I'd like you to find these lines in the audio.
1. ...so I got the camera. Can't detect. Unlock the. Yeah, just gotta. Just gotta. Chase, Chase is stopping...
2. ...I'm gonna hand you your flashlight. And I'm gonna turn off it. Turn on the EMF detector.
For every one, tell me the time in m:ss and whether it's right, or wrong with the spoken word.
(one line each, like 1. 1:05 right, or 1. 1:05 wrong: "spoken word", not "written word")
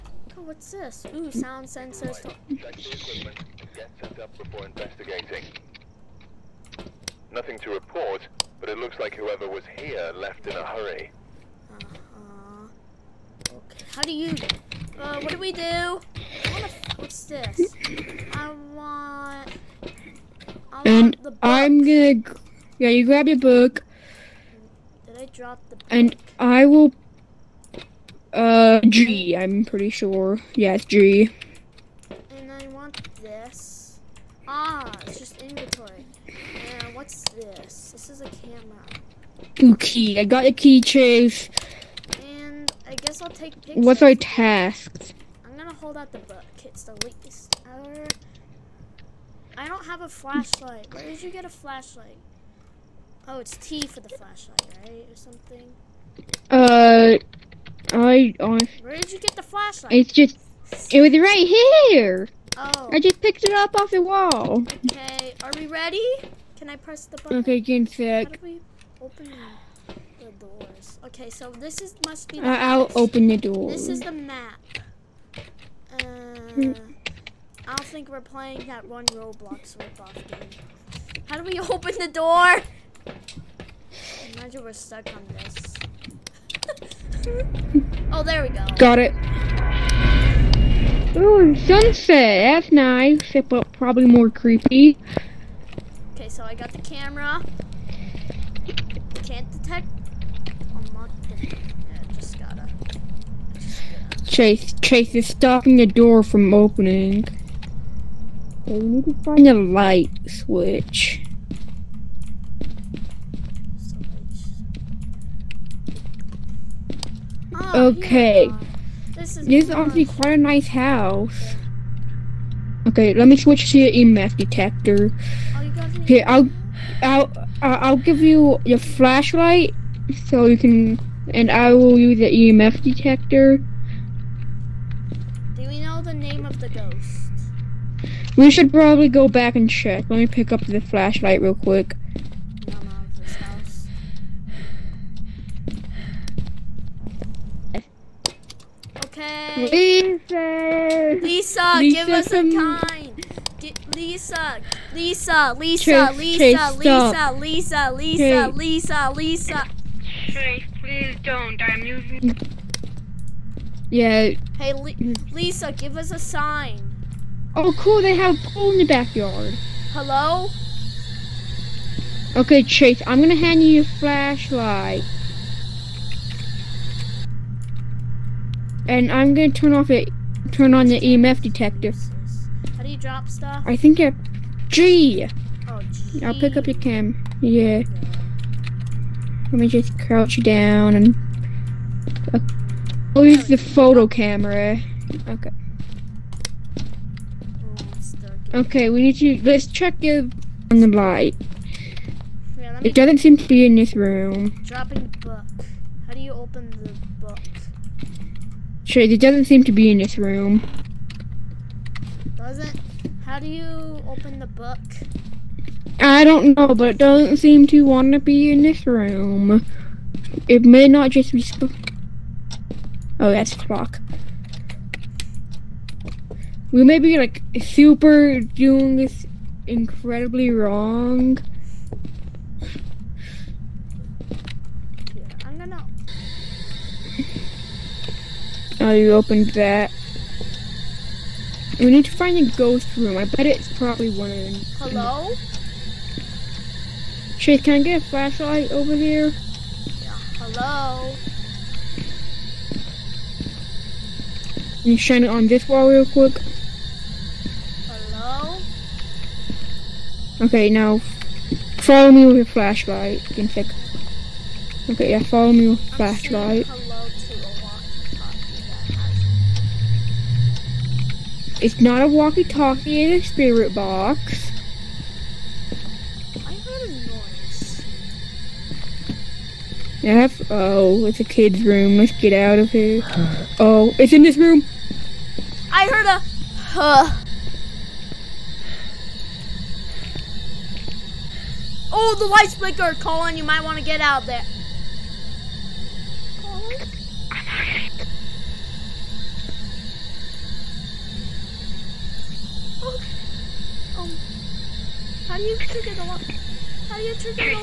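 1. 1:36 right
2. 2:53 right.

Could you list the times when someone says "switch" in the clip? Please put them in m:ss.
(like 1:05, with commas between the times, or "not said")
1:50, 2:03.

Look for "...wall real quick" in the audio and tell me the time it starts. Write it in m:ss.
4:15.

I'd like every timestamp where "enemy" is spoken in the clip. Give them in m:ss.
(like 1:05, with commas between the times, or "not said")
not said.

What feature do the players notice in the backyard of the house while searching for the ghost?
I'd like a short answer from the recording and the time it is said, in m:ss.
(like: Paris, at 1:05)
A pool, at 2:48.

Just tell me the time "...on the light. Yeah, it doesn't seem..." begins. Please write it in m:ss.
3:20.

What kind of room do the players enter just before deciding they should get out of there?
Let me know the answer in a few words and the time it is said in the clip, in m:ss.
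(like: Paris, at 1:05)
A kid's room, at 4:41.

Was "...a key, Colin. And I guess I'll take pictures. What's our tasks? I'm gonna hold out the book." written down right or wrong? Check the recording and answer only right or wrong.
wrong.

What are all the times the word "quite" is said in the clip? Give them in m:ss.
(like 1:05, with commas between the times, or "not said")
2:00.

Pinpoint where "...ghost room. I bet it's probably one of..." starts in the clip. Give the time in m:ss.
4:02.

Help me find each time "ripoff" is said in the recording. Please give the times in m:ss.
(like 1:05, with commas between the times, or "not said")
1:19.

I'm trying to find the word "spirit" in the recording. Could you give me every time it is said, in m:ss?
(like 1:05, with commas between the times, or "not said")
4:33.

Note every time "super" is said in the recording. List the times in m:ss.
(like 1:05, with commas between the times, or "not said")
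3:47.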